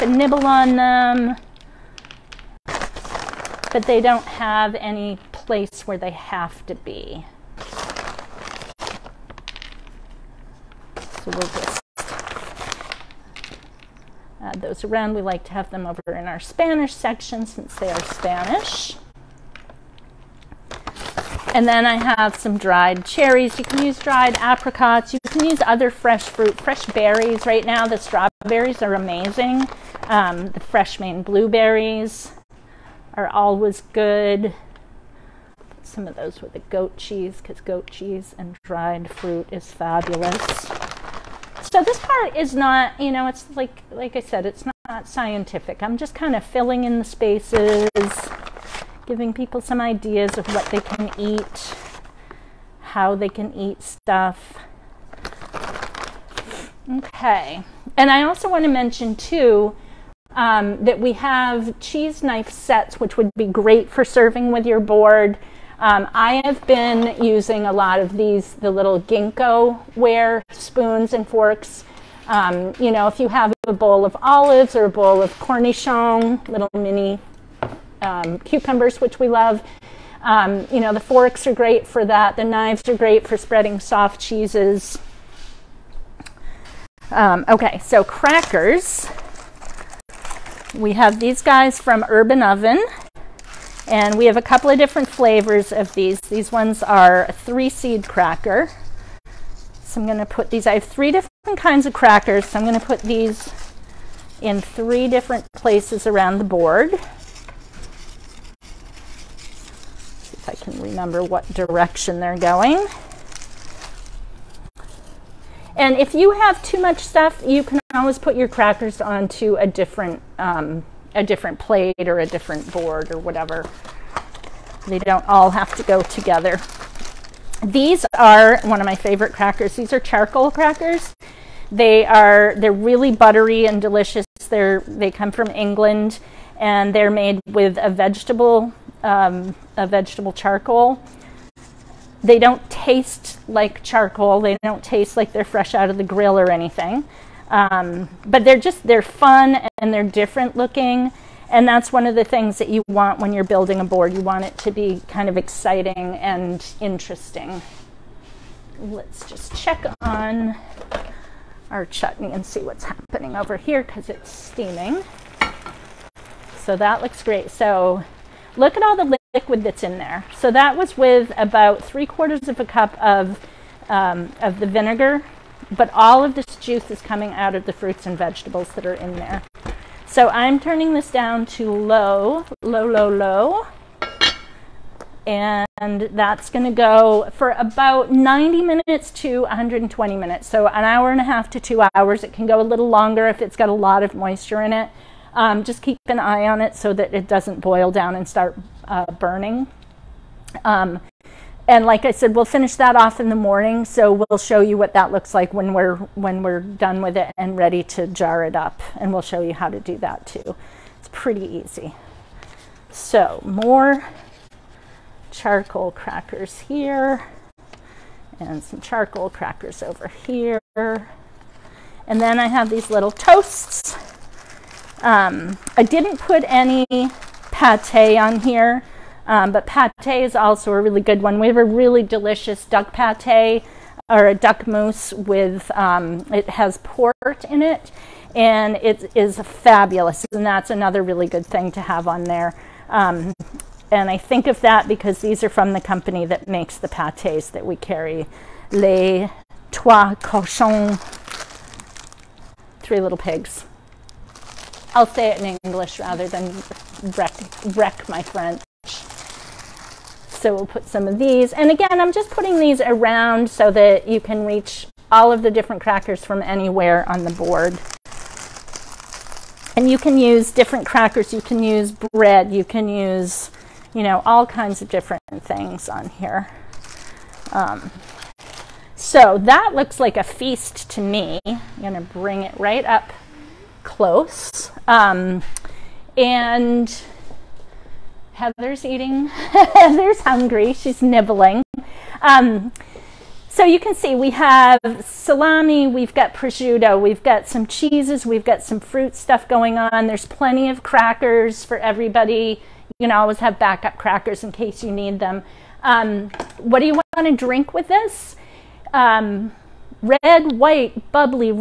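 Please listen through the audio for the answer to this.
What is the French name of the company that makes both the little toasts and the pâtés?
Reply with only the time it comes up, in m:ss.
4:08.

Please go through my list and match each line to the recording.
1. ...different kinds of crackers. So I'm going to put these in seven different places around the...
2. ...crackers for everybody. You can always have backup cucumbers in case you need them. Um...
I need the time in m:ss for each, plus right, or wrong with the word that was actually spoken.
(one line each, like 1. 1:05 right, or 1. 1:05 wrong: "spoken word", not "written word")
1. 1:41 wrong: "three", not "seven"
2. 5:00 wrong: "crackers", not "cucumbers".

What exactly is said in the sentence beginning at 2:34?
You want it to be kind of exciting and interesting.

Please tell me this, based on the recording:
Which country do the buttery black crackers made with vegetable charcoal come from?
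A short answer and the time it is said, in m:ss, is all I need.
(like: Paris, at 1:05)
England, at 2:15.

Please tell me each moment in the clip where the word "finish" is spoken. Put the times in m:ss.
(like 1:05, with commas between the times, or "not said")
3:22.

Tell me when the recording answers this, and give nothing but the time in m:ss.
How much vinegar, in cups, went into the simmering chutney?
2:51.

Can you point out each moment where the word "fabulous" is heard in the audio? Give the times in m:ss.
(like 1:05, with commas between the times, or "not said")
0:39, 3:59.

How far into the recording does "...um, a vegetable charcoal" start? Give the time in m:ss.
2:19.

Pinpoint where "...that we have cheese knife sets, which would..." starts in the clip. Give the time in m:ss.
1:00.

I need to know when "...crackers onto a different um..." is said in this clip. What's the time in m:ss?
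1:58.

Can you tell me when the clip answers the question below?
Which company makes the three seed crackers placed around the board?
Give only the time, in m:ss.
1:32.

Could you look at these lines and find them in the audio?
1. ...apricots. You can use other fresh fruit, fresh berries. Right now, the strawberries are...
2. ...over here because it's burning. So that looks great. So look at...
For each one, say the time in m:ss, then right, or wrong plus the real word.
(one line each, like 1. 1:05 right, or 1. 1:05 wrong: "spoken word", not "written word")
1. 0:24 right
2. 2:43 wrong: "steaming", not "burning".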